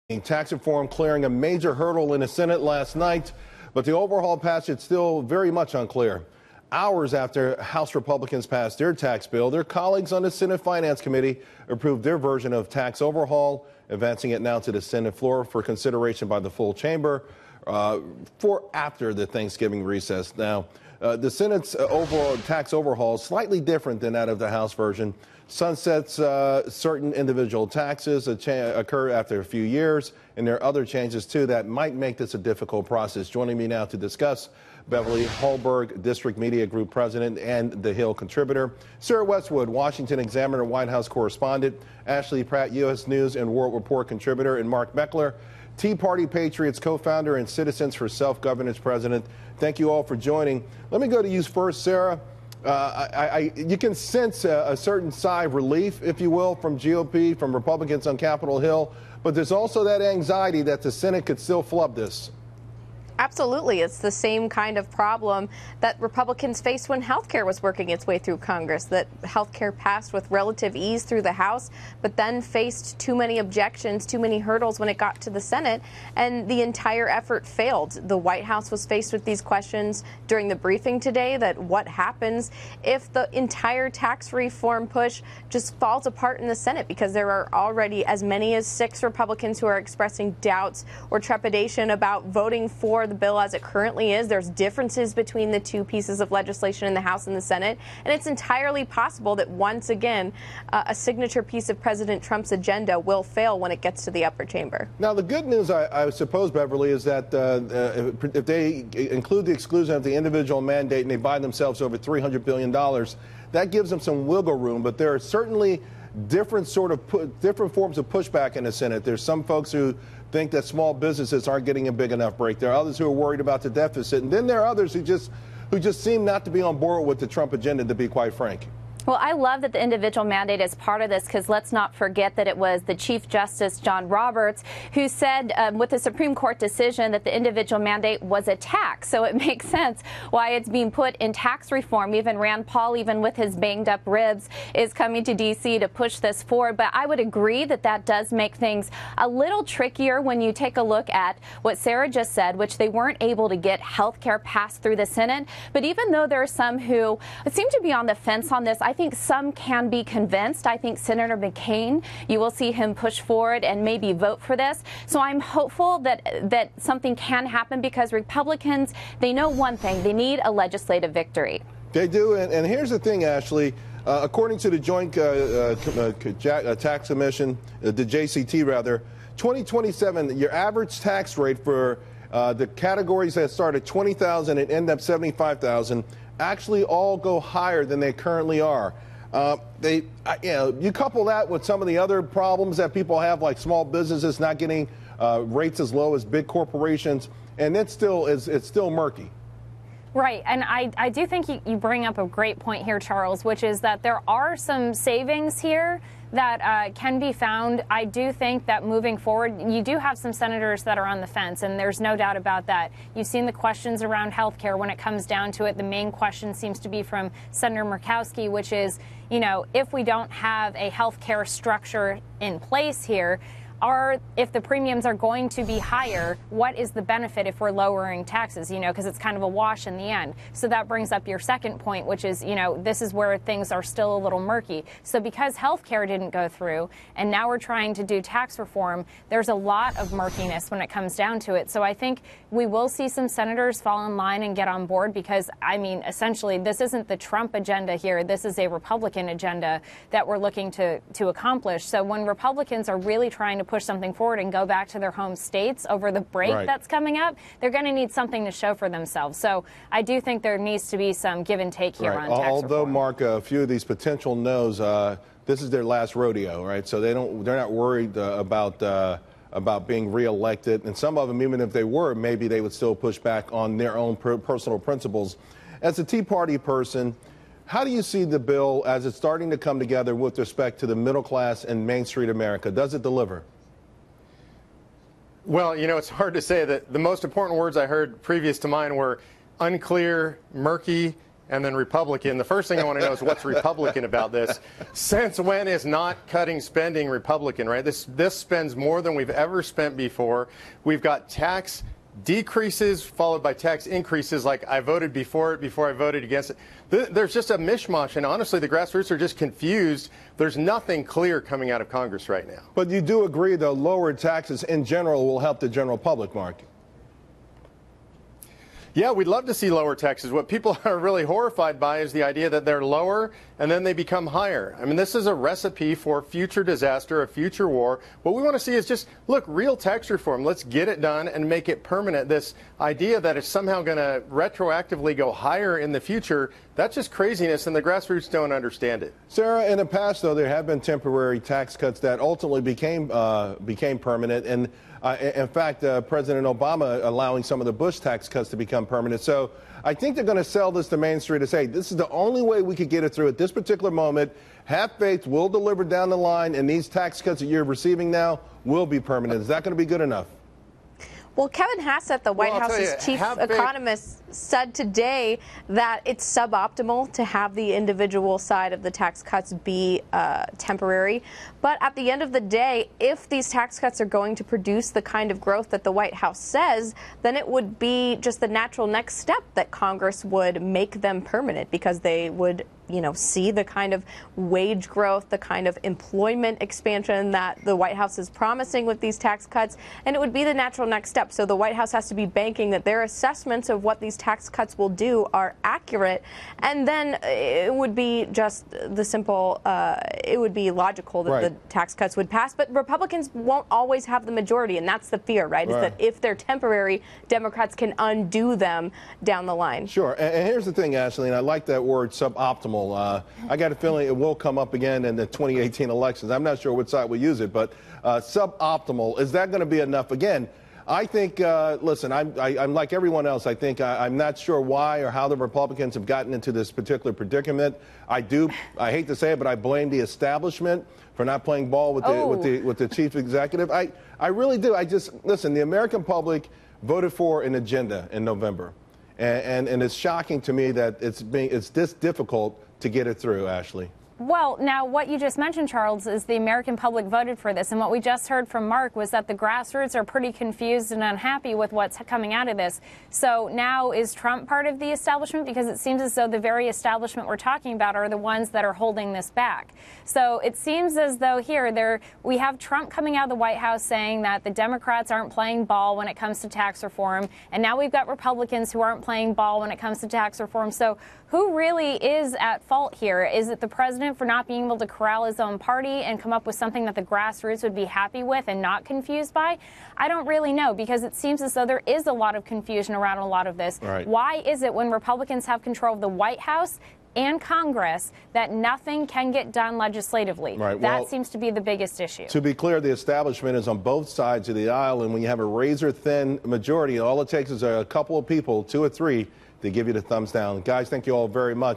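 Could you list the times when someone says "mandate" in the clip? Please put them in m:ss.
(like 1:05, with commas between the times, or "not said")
1:50, 2:10, 2:17.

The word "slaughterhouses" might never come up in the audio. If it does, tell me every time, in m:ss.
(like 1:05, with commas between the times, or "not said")
not said.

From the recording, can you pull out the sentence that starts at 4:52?
The first thing I want to know is what's Republican about this.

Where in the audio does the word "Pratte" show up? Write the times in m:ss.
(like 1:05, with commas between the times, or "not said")
0:42.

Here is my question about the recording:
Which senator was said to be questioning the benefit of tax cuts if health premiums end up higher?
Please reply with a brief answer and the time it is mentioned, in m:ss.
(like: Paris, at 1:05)
Murkowski, at 3:37.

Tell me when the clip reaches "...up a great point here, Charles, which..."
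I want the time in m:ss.
3:22.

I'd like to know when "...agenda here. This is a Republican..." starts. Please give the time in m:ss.
4:07.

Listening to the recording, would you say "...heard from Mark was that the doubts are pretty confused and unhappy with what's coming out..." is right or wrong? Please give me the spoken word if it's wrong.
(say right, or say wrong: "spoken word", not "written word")
wrong: "grassroots", not "doubts".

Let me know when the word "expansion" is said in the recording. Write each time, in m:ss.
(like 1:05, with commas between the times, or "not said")
6:26.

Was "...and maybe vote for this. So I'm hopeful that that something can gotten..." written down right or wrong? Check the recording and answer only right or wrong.
wrong.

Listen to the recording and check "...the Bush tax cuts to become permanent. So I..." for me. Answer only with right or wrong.
right.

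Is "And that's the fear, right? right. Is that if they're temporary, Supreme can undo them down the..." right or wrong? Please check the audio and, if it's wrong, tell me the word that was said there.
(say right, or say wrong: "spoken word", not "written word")
wrong: "Democrats", not "Supreme".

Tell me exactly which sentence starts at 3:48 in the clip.
You know, because it's kind of a wash in the end.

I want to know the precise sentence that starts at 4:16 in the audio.
that's coming up, they're going to need something to show for themselves.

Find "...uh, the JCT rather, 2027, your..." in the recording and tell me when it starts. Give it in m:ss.
2:57.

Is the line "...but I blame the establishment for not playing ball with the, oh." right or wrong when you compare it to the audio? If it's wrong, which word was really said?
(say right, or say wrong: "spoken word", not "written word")
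right.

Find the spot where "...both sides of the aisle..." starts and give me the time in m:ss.
8:13.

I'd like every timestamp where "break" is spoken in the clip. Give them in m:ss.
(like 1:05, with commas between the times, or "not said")
2:02, 4:16.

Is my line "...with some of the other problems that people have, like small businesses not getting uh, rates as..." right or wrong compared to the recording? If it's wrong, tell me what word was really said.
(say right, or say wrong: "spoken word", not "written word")
right.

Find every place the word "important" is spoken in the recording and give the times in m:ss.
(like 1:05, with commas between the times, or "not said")
4:47.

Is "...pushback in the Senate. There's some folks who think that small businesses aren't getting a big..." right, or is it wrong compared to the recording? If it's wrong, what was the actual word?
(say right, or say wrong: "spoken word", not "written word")
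right.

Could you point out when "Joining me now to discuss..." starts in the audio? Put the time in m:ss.
0:33.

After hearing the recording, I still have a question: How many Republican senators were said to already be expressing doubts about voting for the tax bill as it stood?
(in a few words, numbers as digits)
6.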